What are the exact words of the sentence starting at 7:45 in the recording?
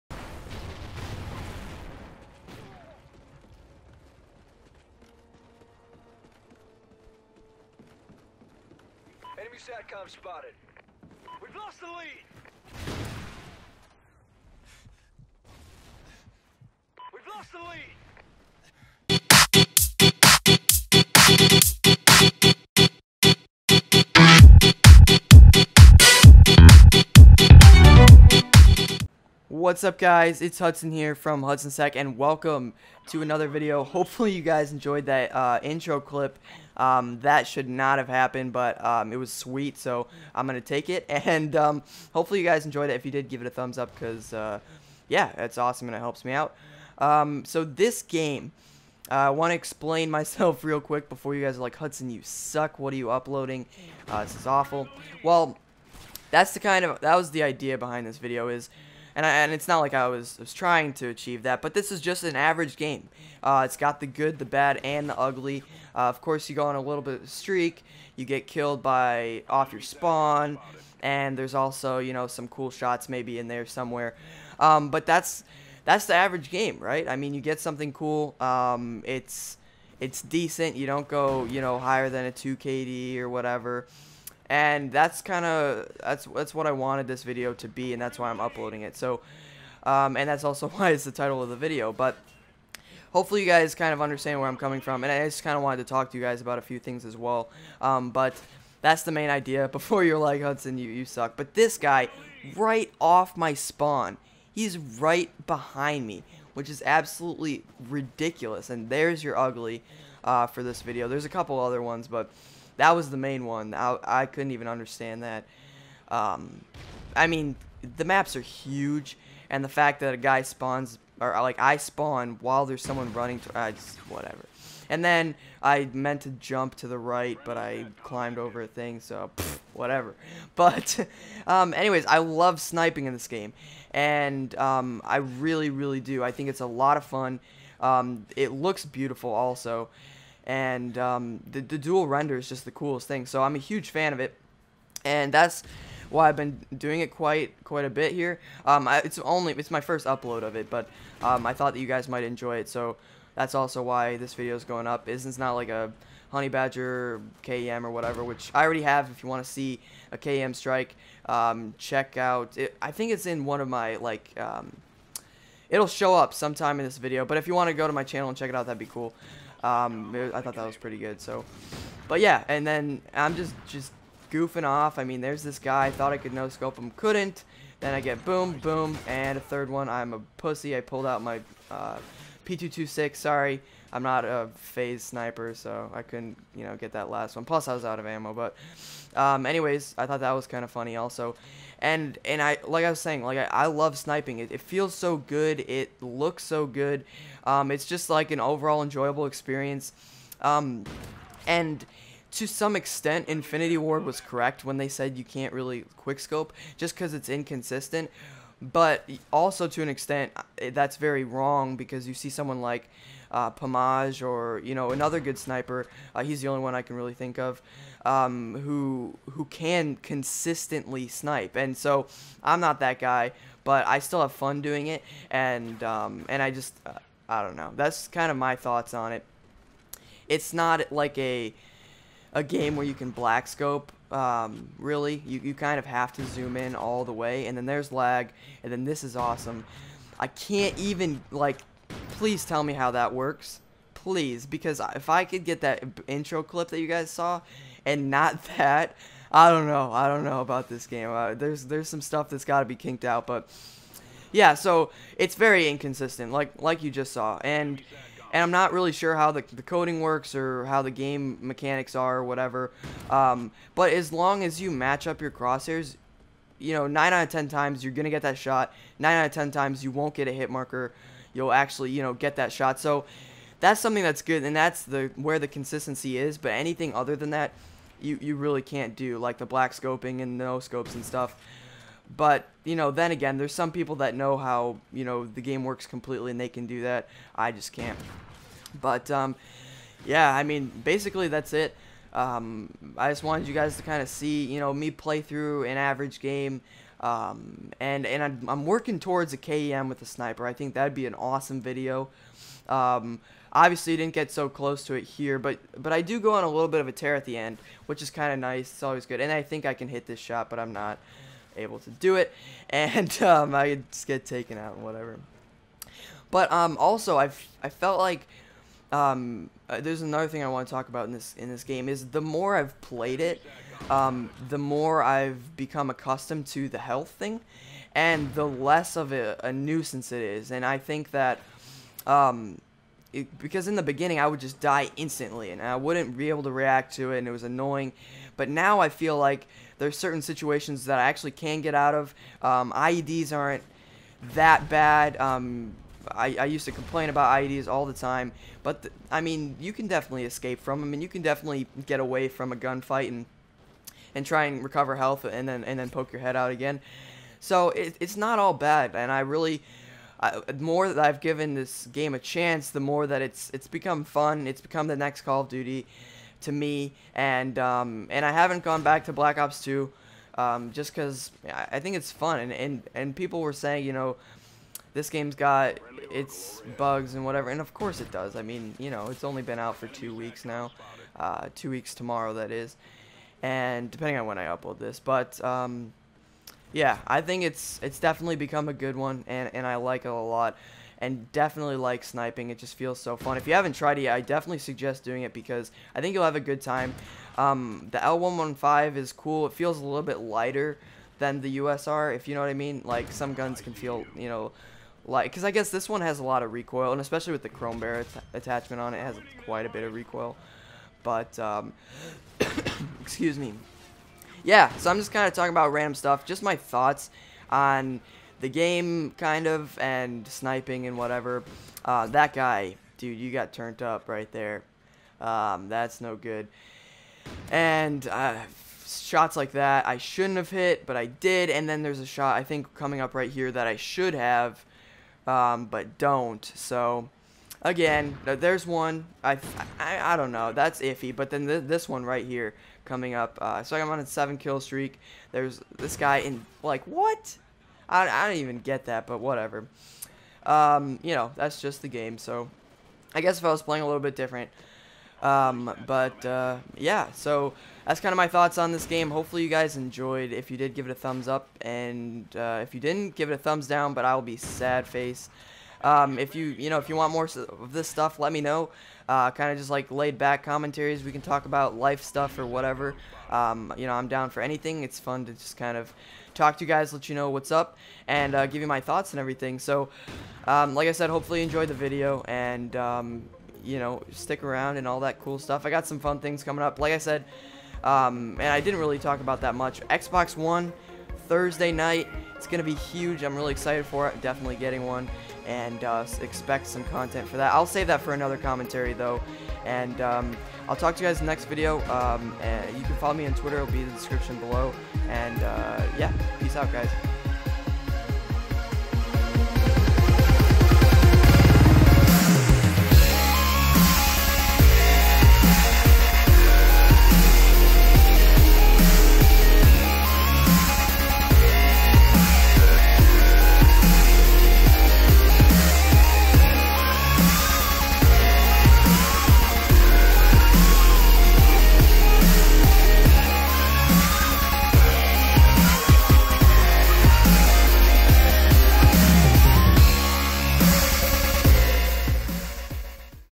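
Um, if you you know if you want more of this stuff, let me know.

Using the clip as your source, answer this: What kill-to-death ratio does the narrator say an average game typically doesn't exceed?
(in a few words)
2 KD.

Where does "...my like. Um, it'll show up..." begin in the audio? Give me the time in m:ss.
2:43.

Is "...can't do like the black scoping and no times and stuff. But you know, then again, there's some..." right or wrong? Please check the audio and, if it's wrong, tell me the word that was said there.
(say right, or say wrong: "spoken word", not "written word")
wrong: "scopes", not "times".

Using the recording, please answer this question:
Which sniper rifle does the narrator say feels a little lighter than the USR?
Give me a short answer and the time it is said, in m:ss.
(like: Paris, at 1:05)
L115, at 6:37.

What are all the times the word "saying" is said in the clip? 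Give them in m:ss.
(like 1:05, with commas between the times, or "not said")
3:13, 6:13.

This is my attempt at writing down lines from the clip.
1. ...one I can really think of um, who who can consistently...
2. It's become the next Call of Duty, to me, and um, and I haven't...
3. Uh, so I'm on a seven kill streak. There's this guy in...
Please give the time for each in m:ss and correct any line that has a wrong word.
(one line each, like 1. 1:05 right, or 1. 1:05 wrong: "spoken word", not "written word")
1. 3:36 right
2. 6:04 right
3. 7:23 right.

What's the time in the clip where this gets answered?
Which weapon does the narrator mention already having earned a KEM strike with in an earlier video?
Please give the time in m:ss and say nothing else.
2:36.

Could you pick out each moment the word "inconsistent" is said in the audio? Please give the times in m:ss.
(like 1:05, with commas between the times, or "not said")
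3:27, 4:15.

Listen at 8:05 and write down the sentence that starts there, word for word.
I got some fun things coming up.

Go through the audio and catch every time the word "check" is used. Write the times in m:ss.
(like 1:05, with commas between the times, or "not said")
2:41, 2:48.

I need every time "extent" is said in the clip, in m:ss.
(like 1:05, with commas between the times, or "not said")
3:22, 3:29.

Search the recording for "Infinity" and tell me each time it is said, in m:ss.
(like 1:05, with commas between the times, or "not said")
3:23.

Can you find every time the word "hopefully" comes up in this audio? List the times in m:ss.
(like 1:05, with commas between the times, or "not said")
0:33, 0:42, 1:33, 7:39, 8:01.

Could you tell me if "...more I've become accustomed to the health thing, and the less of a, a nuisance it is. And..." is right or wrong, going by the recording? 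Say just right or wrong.
right.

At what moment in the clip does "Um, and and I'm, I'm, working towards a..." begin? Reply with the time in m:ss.
4:56.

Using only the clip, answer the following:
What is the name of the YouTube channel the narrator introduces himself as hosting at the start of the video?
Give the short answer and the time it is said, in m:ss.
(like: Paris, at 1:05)
HudsonsTech, at 0:31.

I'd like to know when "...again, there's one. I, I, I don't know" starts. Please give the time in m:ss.
7:17.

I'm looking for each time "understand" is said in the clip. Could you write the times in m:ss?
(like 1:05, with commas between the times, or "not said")
1:34, 1:54.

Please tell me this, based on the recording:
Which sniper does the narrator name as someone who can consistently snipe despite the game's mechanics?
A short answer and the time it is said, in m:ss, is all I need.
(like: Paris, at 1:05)
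Pamaj, at 3:33.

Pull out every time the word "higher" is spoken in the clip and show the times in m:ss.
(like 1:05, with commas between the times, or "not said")
1:21.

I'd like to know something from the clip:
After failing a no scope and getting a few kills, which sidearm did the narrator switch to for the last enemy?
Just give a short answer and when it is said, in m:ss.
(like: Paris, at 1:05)
P226, at 3:02.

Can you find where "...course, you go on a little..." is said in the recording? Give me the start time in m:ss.
1:06.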